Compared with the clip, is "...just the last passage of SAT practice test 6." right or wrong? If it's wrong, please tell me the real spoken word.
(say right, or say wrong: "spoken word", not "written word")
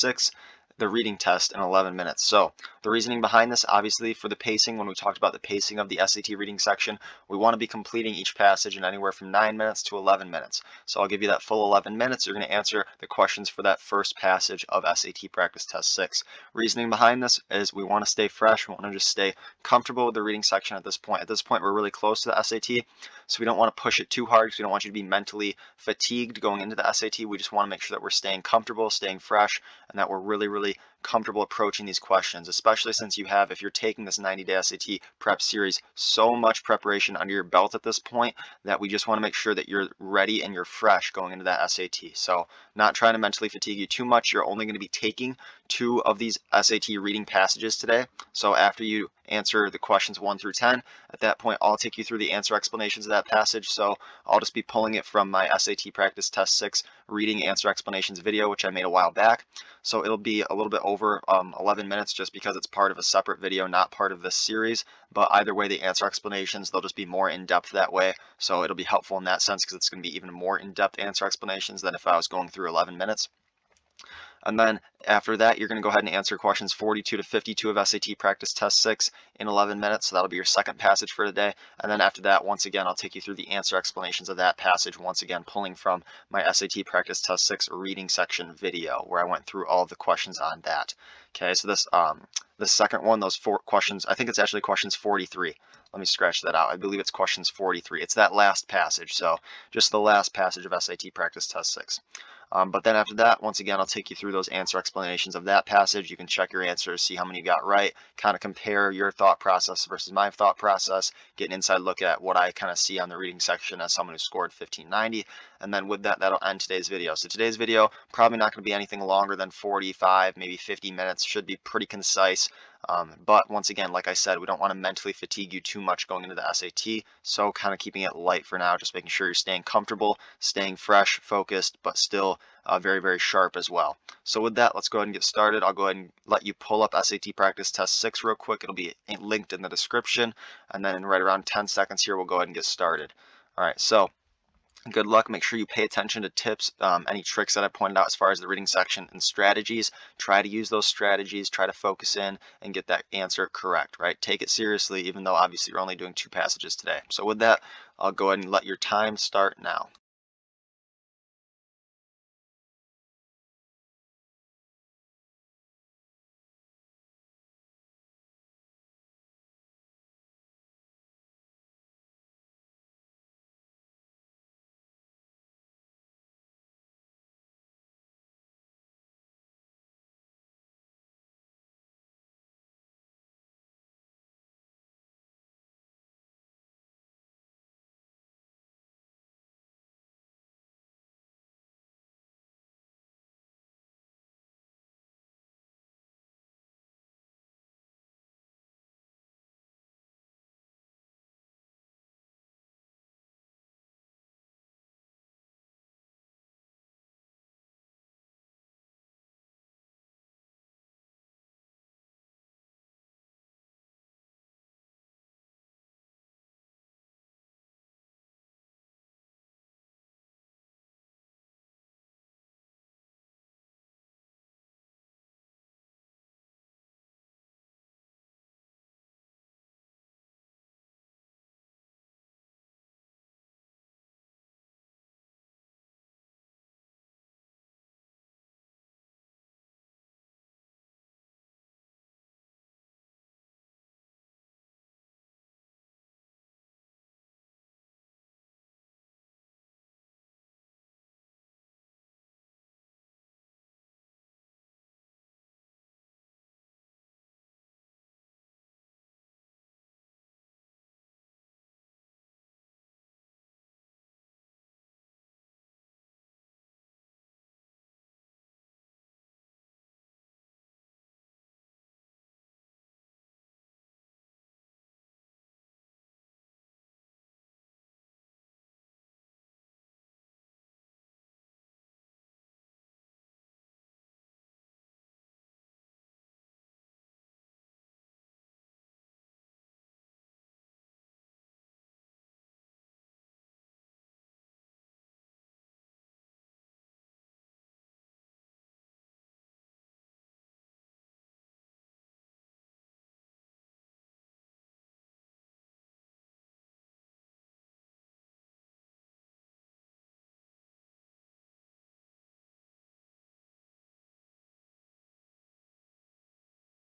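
right.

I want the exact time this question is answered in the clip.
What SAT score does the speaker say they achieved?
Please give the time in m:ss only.
1:54.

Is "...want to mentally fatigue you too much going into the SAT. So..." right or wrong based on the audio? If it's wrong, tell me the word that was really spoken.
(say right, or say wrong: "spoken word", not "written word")
right.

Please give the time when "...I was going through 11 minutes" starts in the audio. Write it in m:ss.
1:12.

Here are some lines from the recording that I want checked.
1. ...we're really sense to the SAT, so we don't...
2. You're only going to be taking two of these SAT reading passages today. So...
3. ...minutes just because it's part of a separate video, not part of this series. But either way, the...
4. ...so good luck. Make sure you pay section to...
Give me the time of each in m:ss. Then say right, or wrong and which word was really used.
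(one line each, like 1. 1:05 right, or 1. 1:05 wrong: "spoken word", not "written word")
1. 0:21 wrong: "close", not "sense"
2. 0:44 right
3. 1:01 right
4. 2:23 wrong: "attention", not "section".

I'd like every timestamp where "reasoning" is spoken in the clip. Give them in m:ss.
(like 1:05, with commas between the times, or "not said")
0:02, 0:16.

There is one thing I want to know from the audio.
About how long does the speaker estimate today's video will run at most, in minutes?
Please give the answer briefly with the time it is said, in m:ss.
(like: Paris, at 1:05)
50, at 2:00.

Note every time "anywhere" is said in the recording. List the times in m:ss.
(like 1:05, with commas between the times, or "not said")
0:08.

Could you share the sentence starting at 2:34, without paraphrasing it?
Take it seriously, even though obviously you're only doing two passages today.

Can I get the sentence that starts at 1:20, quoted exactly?
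So that'll be your second passage for the day.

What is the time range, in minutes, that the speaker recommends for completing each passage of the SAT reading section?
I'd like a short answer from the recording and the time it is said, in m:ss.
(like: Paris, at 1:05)
9 to 11 minutes, at 0:09.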